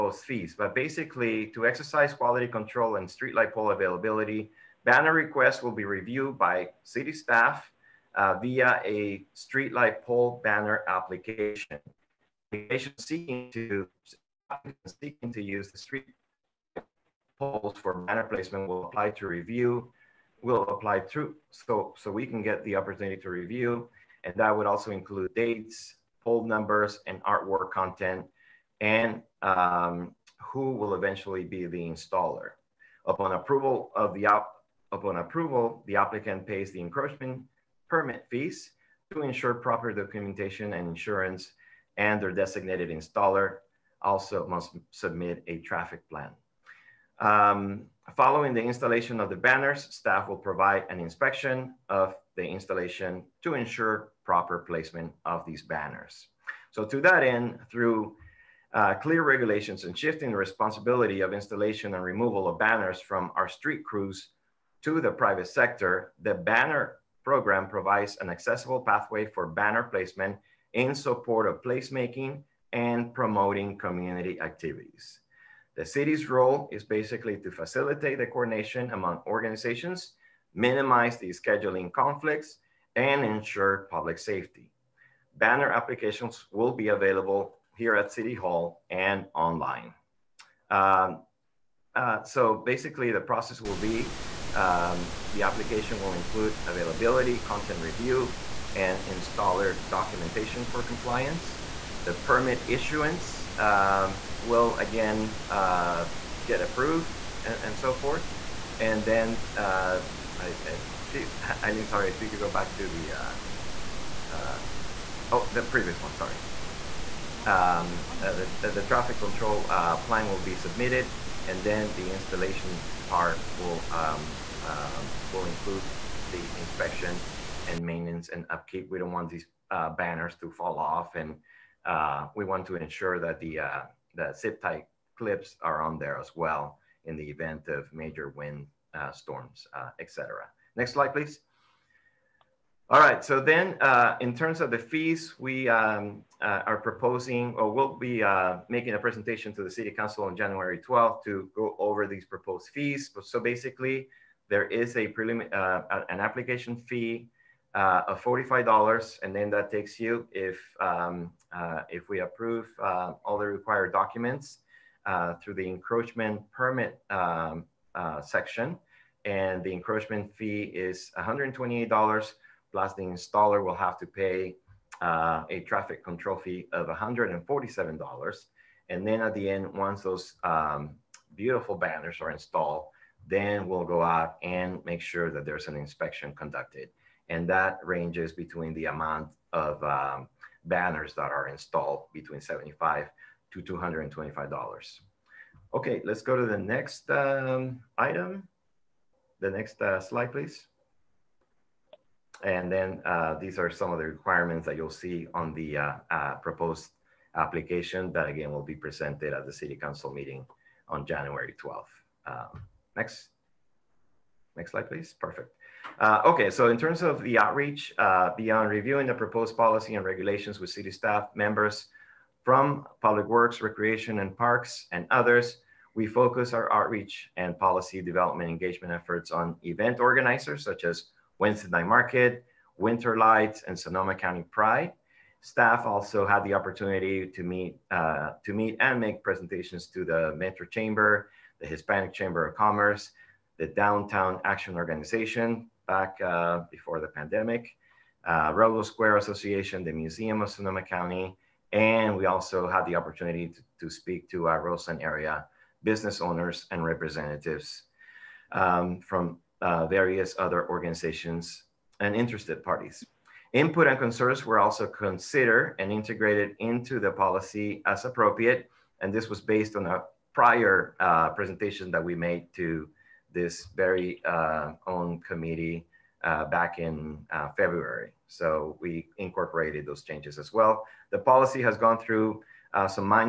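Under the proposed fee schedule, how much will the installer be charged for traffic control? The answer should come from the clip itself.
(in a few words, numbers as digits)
$147.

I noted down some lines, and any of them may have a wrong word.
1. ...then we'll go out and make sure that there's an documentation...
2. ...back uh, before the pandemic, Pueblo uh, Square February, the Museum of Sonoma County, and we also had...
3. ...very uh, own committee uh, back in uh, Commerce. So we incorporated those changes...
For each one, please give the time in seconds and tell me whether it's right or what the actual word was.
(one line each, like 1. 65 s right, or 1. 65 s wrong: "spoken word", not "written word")
1. 183 s wrong: "inspection", not "documentation"
2. 245 s wrong: "Association", not "February"
3. 273 s wrong: "February", not "Commerce".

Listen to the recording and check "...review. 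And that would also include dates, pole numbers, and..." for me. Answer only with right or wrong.
right.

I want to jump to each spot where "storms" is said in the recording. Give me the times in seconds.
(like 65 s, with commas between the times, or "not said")
139 s.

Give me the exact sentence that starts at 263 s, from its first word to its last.
Input and concerns were also considered and integrated into the policy as appropriate.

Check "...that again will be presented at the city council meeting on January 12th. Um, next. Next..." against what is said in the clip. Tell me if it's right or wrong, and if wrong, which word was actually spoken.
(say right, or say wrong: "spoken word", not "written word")
right.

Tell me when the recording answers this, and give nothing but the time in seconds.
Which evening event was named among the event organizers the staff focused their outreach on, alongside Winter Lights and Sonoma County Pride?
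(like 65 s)
231 s.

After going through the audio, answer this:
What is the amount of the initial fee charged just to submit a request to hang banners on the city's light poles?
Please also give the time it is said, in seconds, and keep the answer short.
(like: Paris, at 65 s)
$45, at 158 s.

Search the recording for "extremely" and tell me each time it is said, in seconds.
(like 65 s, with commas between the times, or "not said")
not said.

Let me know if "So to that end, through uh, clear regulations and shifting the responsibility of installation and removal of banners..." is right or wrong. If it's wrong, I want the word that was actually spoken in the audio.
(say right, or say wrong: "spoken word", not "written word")
right.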